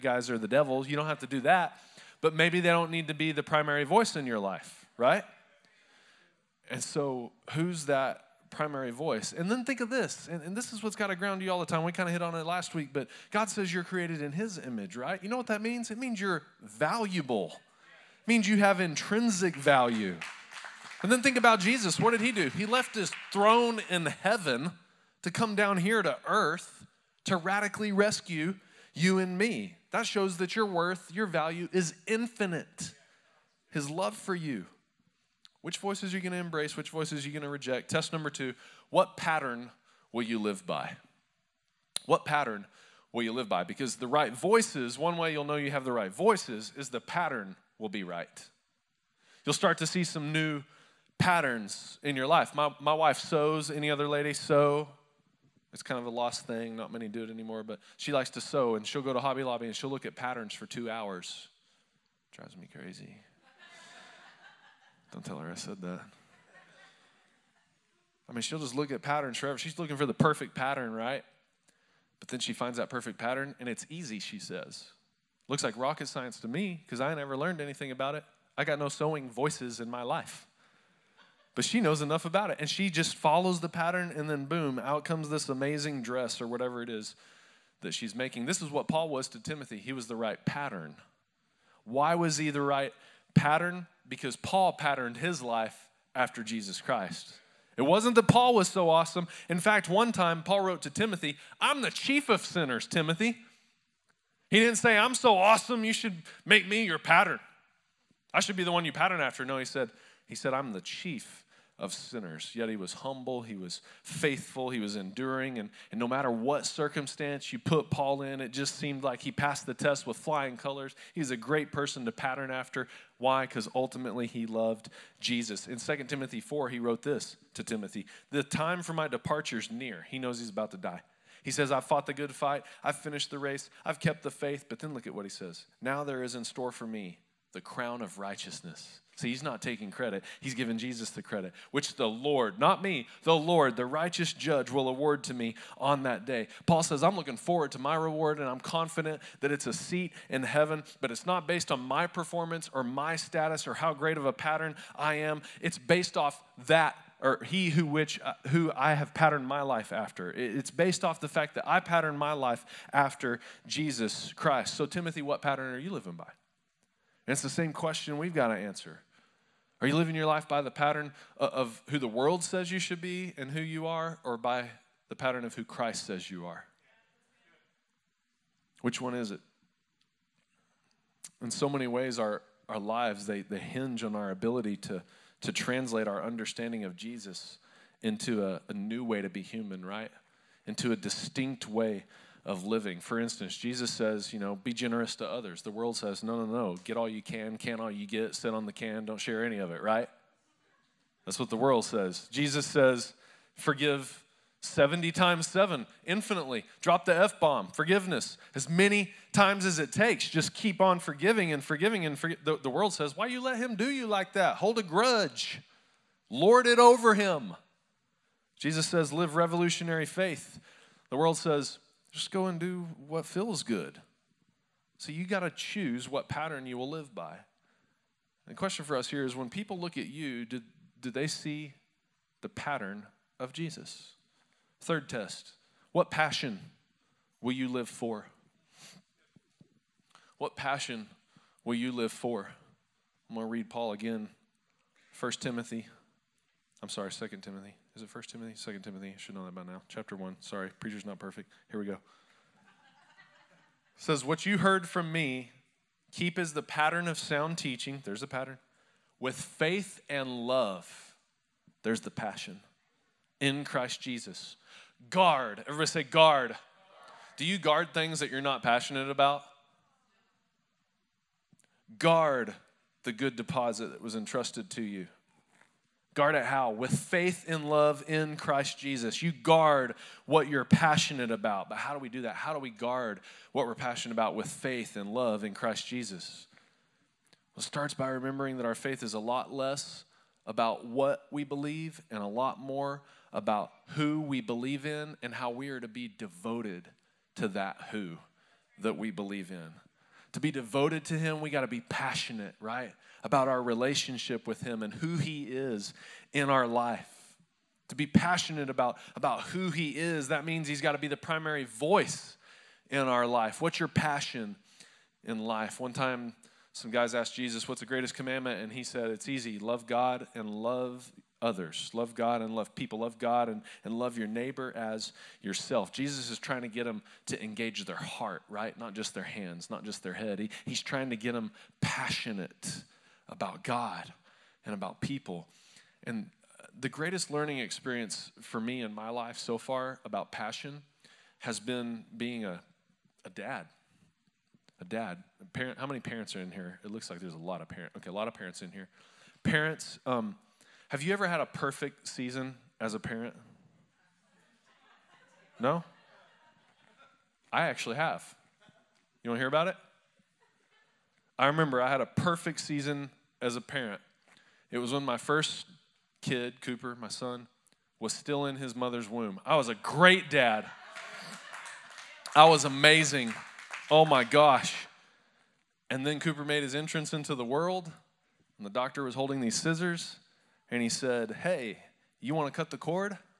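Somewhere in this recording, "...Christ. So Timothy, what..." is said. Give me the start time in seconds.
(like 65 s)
164 s.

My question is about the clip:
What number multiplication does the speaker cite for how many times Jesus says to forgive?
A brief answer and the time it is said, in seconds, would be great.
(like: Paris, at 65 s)
70 times 7, at 204 s.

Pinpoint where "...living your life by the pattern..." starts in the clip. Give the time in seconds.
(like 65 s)
169 s.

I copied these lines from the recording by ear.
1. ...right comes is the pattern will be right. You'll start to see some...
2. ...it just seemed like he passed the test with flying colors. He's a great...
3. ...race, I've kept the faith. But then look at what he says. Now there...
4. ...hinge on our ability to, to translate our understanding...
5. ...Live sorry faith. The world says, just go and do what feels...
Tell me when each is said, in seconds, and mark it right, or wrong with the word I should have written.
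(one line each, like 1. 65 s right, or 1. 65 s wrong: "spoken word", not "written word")
1. 45 s wrong: "voices", not "comes"
2. 118 s right
3. 133 s right
4. 183 s right
5. 219 s wrong: "revolutionary", not "sorry".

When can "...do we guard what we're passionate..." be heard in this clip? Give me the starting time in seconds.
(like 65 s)
282 s.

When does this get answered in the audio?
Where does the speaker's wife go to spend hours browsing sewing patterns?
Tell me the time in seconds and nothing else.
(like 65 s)
59 s.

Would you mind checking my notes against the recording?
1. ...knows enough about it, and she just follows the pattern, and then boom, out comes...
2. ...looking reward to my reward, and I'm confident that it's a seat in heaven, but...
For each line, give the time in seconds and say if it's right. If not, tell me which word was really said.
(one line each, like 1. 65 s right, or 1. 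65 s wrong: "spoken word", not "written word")
1. 81 s right
2. 147 s wrong: "forward", not "reward".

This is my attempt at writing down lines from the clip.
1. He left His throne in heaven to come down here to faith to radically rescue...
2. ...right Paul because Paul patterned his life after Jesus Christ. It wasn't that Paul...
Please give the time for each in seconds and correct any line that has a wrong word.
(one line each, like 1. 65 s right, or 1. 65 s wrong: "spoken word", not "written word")
1. 22 s wrong: "earth", not "faith"
2. 92 s wrong: "Pattern", not "Paul".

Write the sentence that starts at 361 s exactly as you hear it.
I remember I had a perfect season as a parent.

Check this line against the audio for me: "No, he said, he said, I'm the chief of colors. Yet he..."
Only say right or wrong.
wrong.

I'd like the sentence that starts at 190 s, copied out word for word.
Into a distinct way of living.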